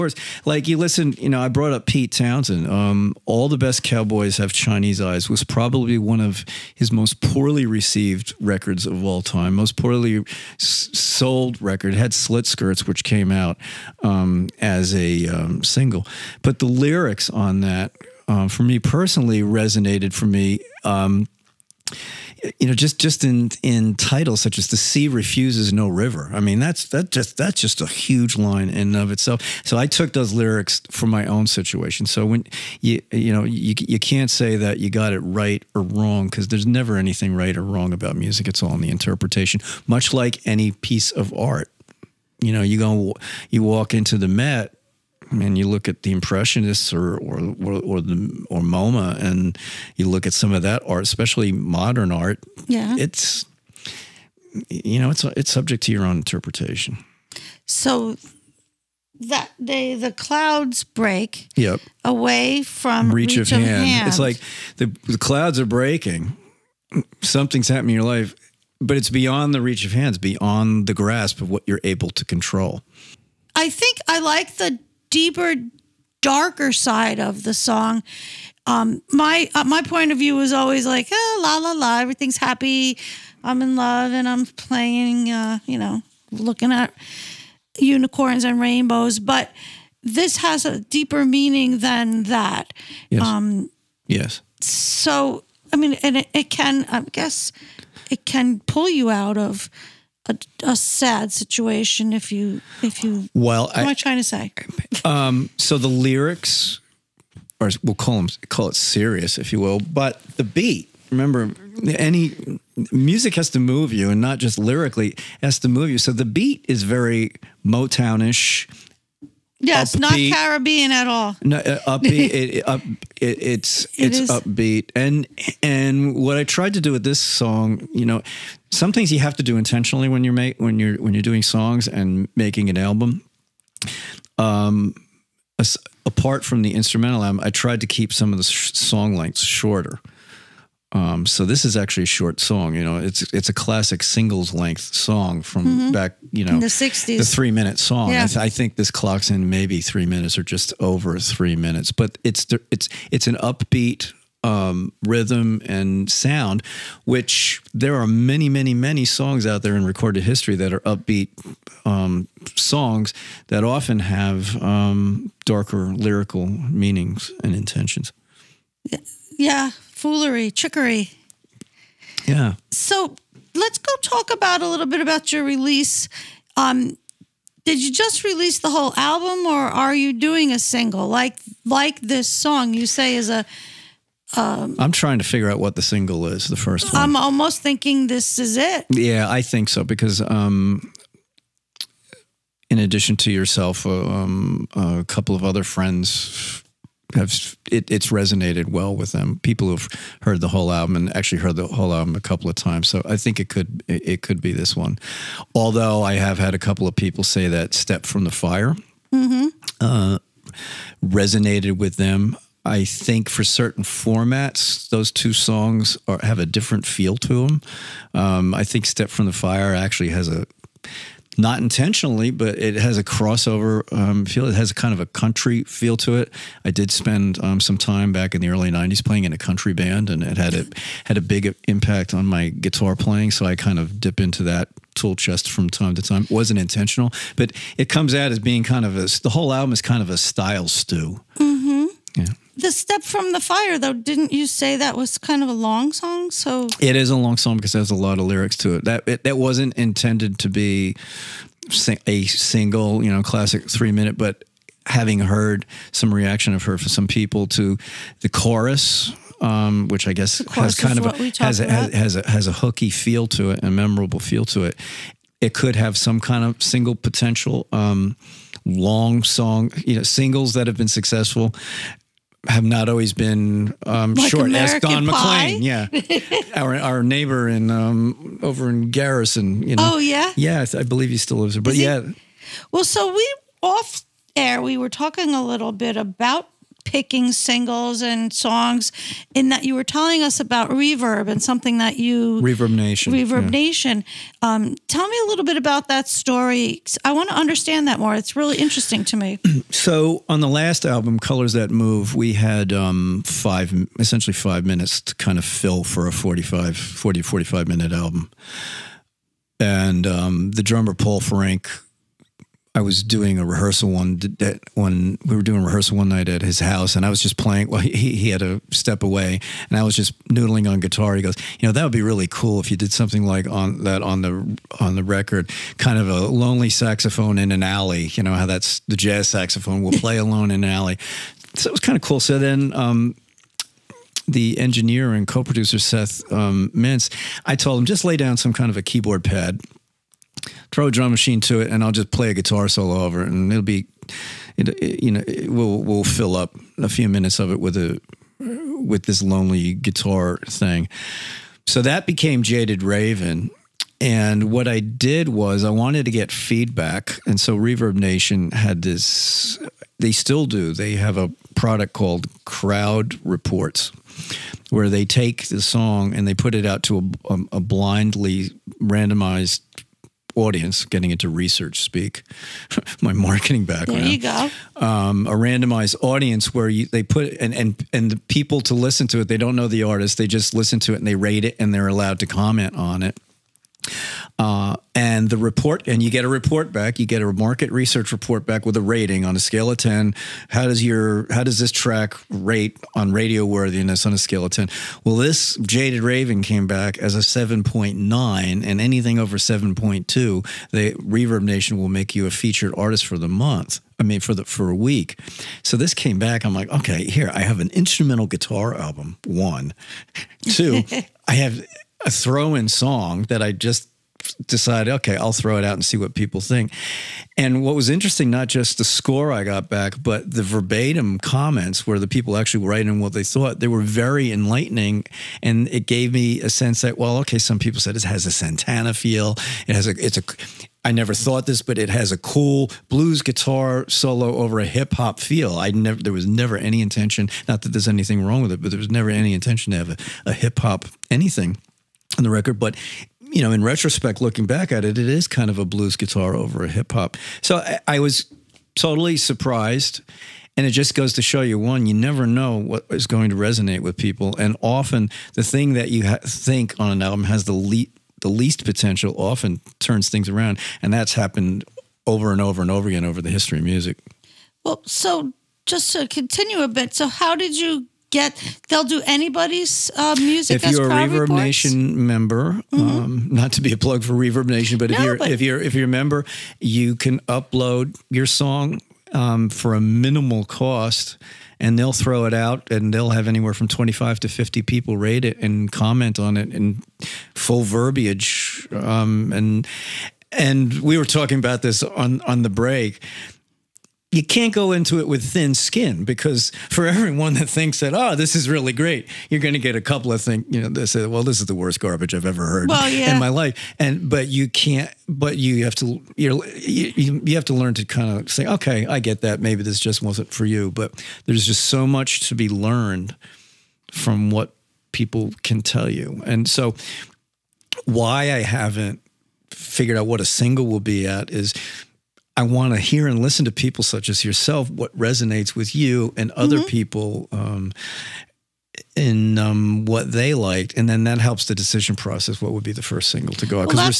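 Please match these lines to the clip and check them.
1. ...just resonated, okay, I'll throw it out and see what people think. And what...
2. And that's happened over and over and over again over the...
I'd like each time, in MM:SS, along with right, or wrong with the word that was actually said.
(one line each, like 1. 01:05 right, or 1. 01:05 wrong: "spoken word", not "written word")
1. 06:53 wrong: "decided", not "resonated"
2. 07:40 right.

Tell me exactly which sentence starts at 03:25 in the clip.
Although I have had a couple of people say that "Step from the Fire" mm -hmm.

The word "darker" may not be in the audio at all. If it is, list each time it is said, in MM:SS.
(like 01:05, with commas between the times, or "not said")
01:16, 02:45.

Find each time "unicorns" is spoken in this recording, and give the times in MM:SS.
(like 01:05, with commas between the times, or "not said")
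01:27.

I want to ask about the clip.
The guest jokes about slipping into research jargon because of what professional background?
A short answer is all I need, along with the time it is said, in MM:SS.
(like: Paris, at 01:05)
marketing, at 06:13.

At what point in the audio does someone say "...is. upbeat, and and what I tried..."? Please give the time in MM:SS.
02:04.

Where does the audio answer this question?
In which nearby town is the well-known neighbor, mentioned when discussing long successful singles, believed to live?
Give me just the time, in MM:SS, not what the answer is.
04:38.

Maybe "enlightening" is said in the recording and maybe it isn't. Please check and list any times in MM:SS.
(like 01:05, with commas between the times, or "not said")
07:04.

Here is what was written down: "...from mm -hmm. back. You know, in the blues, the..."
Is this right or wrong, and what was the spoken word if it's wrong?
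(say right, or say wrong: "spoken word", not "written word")
wrong: "sixties", not "blues".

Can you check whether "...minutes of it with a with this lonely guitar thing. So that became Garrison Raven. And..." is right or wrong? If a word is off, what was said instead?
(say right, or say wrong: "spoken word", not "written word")
wrong: "Jaded", not "Garrison".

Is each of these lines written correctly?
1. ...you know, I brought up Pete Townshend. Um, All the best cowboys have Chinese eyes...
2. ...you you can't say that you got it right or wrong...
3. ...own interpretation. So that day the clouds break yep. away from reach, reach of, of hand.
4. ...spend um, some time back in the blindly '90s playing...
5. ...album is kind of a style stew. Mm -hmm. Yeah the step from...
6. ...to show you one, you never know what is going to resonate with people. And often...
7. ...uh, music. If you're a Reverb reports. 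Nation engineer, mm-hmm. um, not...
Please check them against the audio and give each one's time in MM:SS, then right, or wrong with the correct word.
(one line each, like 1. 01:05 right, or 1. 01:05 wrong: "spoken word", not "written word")
1. 00:01 right
2. 00:33 right
3. 00:56 right
4. 03:46 wrong: "early", not "blindly"
5. 03:59 right
6. 07:31 right
7. 07:49 wrong: "member", not "engineer".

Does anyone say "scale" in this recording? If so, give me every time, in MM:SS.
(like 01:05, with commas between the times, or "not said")
06:29, 06:34.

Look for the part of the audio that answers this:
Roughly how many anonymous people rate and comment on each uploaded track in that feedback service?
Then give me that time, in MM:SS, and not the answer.
08:03.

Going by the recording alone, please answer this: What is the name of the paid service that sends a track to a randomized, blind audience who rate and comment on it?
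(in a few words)
Crowd Reports.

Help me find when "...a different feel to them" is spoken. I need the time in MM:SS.
03:36.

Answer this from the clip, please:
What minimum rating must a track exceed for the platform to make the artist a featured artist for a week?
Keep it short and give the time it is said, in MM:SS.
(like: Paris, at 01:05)
7.2, at 06:39.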